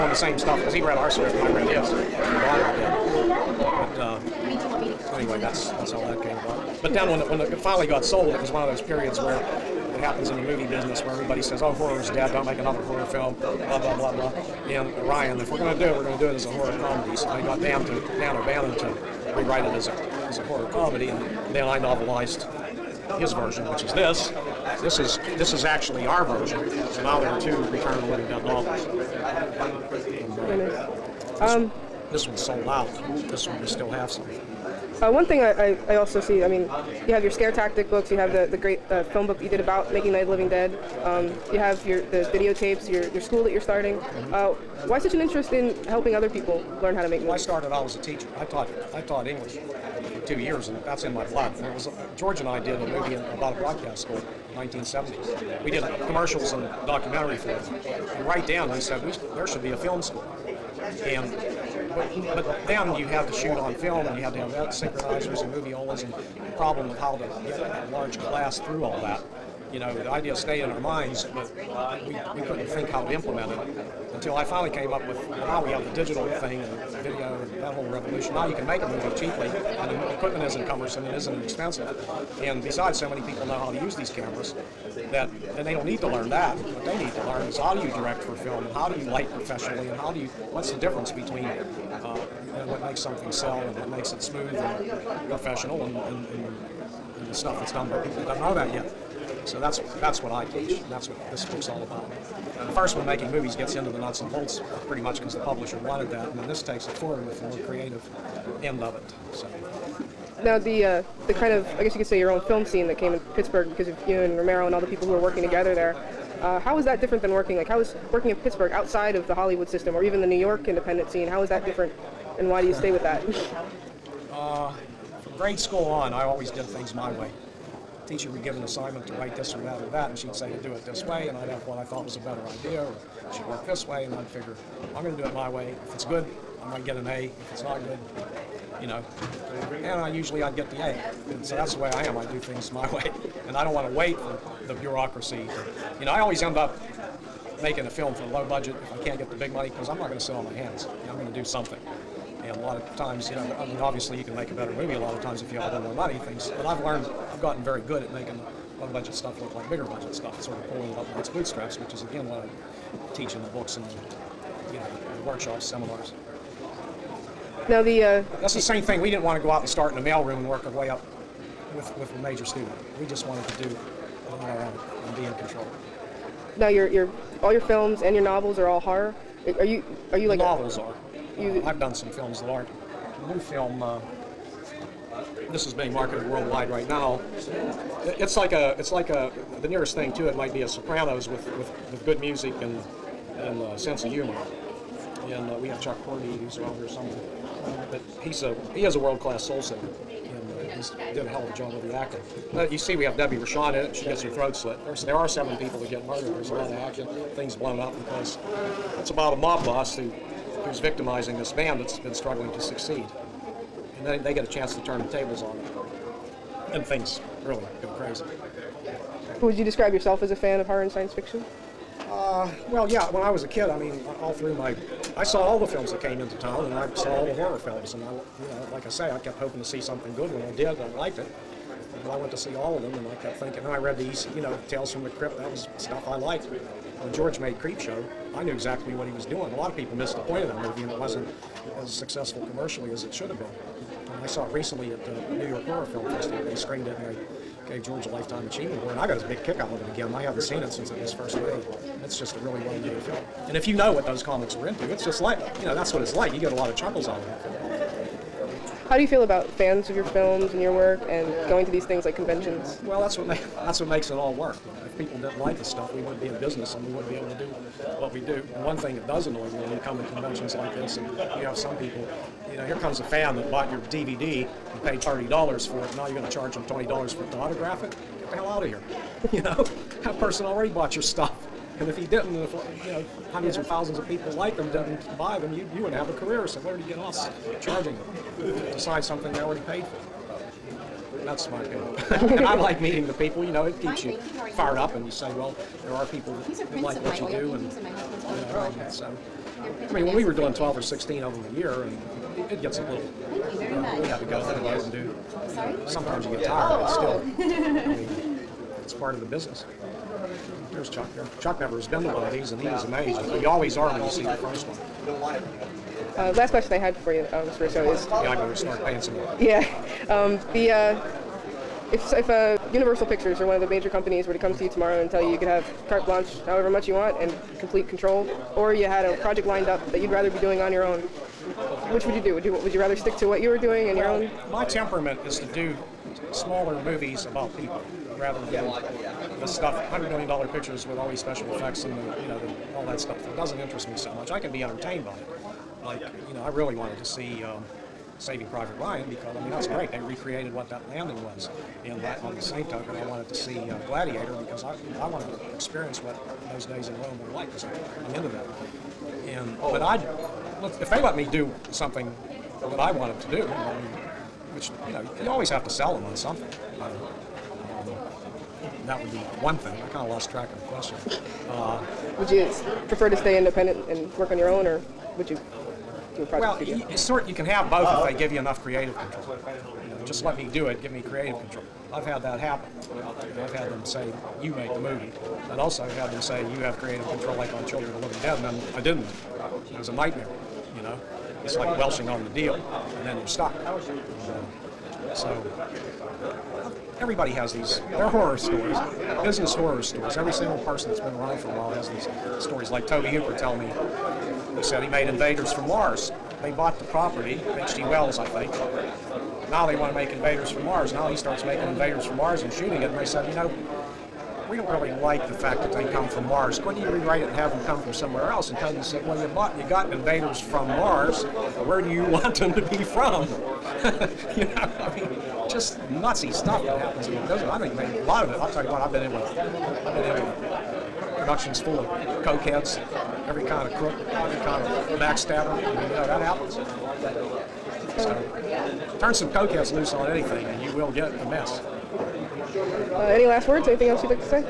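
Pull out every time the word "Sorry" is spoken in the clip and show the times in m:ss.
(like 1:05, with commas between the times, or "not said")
5:05.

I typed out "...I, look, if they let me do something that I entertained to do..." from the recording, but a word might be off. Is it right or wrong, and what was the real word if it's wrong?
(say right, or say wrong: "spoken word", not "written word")
wrong: "wanted", not "entertained".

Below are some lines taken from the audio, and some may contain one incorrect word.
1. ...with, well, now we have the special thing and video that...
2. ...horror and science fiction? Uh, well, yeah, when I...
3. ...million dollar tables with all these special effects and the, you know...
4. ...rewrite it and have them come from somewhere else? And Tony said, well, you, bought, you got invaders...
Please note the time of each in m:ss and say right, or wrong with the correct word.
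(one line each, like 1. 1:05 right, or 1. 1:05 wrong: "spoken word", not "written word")
1. 1:15 wrong: "digital", not "special"
2. 3:40 right
3. 5:40 wrong: "pictures", not "tables"
4. 6:56 right.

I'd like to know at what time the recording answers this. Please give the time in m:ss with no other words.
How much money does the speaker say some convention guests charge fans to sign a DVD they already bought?
4:36.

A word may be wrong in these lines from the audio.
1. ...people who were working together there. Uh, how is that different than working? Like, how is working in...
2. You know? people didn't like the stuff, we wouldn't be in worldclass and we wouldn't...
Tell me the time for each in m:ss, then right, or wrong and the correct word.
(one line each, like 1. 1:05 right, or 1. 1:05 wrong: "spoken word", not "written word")
1. 1:54 right
2. 4:24 wrong: "business", not "worldclass".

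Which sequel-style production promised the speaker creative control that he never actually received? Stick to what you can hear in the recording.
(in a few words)
Children of the Living Dead.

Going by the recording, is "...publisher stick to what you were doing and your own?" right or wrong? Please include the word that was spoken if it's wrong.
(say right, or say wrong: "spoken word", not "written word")
wrong: "rather", not "publisher".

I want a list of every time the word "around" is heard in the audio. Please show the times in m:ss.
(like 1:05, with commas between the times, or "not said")
3:16, 6:41.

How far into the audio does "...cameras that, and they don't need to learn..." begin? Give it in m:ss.
1:24.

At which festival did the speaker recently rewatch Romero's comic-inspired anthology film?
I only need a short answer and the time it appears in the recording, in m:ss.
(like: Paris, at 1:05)
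New York Horror Film Festival, at 4:05.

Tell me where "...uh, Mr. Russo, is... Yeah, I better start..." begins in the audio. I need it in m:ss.
5:17.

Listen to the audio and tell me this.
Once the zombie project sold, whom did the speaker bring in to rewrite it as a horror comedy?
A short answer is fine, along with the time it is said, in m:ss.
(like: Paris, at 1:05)
Dan O'Bannon, at 0:18.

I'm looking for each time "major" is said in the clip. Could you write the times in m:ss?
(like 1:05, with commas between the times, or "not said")
2:52, 5:23.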